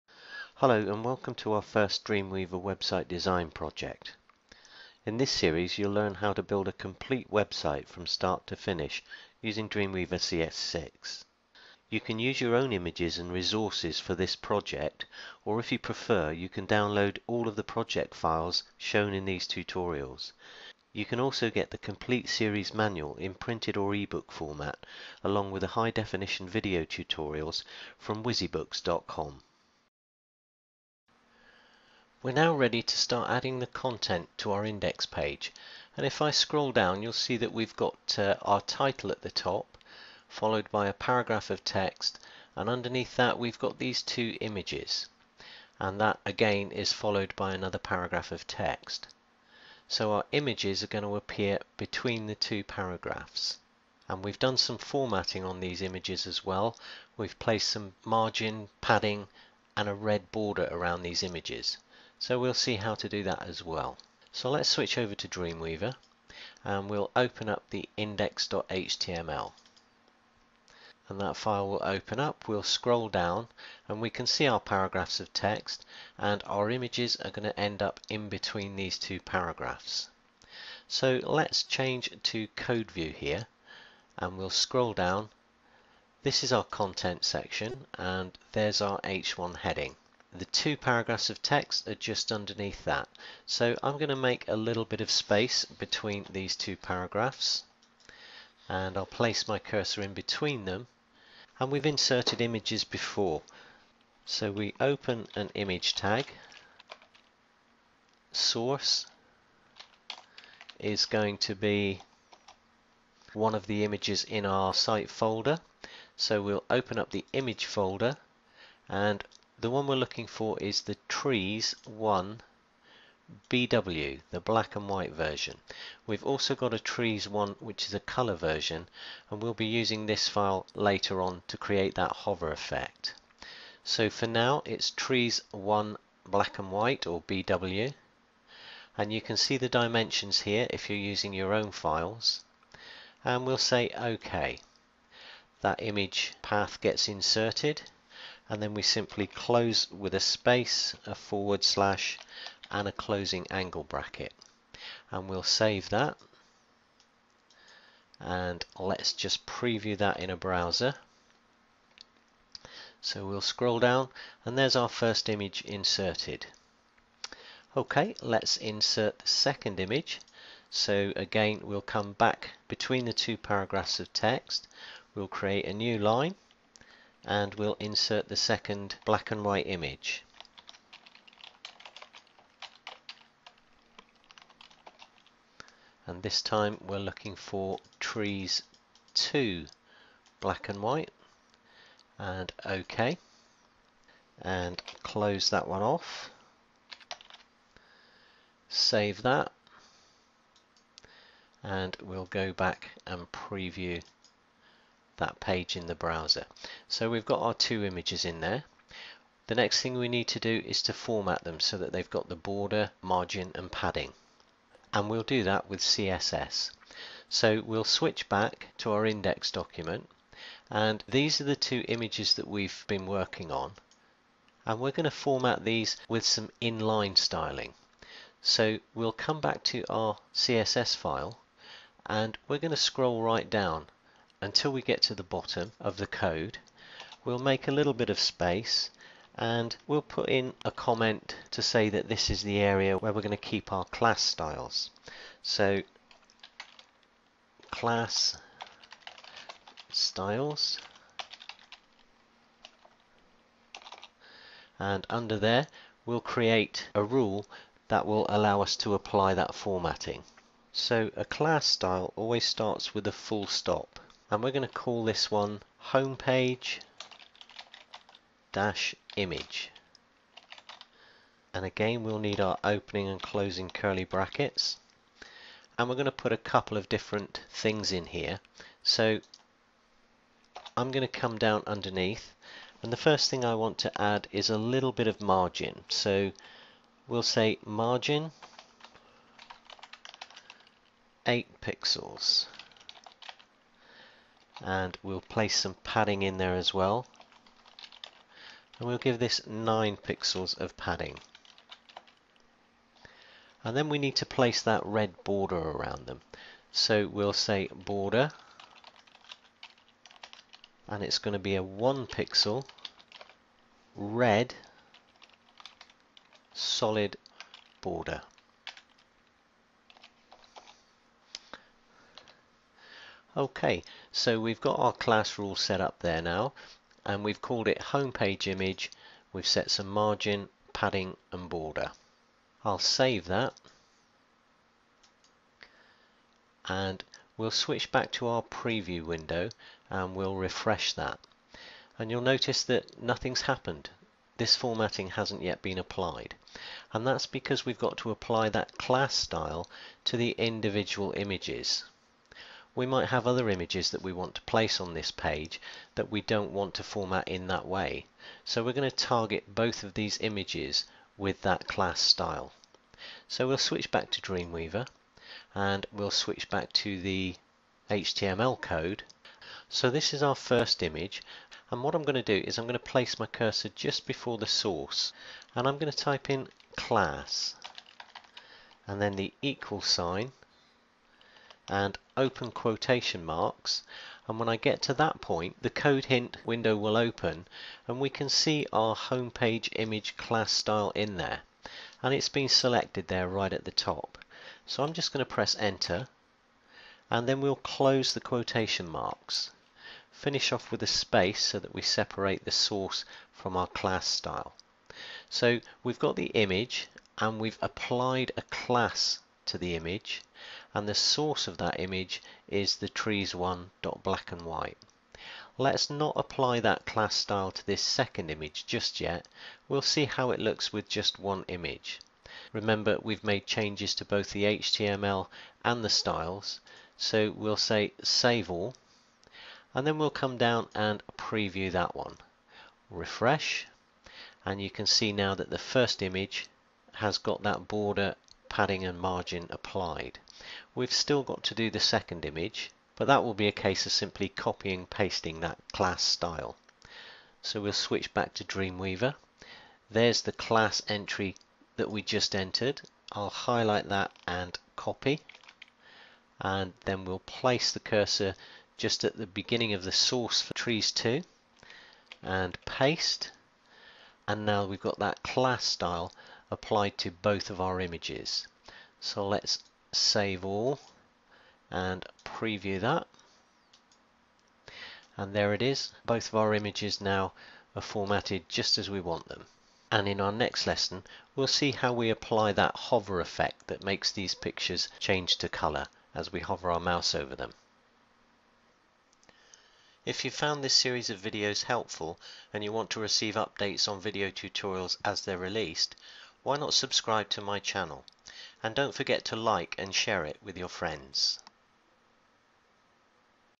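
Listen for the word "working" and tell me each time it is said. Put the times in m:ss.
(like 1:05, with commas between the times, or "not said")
3:43.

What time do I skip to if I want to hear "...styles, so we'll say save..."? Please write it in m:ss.
7:05.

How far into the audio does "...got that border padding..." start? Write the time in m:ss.
7:17.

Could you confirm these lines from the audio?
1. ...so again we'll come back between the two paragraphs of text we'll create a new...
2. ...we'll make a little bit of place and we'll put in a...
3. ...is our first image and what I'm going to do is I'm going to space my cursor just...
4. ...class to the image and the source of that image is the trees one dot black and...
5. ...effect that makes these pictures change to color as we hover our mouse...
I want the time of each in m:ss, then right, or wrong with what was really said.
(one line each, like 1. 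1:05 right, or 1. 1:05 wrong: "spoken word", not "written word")
1. 2:50 right
2. 3:57 wrong: "space", not "place"
3. 6:10 wrong: "place", not "space"
4. 6:48 right
5. 8:03 right.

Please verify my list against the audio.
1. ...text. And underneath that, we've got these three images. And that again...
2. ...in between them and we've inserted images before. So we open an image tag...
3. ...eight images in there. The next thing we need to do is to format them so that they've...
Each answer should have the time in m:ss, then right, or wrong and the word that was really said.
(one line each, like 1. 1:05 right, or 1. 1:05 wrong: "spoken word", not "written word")
1. 0:41 wrong: "two", not "three"
2. 1:40 right
3. 3:27 wrong: "two", not "eight".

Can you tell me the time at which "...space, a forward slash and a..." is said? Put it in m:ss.
2:30.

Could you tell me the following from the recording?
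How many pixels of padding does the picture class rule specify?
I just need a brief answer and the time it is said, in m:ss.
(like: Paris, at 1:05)
9, at 4:59.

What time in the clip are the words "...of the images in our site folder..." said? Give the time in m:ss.
1:53.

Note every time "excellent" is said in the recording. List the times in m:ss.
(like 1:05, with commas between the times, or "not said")
not said.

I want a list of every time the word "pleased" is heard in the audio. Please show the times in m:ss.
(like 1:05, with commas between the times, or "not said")
not said.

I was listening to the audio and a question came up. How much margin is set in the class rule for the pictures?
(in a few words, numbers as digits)
8 pixels.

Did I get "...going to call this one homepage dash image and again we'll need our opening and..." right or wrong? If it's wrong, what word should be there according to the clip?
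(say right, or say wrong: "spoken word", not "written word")
right.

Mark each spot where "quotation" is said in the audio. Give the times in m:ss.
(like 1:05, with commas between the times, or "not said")
6:22, 6:38.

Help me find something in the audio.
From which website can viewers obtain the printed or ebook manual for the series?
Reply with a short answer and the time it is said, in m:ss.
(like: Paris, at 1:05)
WizzyBooks.com, at 0:28.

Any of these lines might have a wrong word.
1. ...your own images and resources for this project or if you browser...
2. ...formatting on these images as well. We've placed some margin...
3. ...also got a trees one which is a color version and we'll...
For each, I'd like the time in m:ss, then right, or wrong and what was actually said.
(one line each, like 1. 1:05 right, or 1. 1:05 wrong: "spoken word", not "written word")
1. 0:12 wrong: "prefer", not "browser"
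2. 0:54 right
3. 2:06 right.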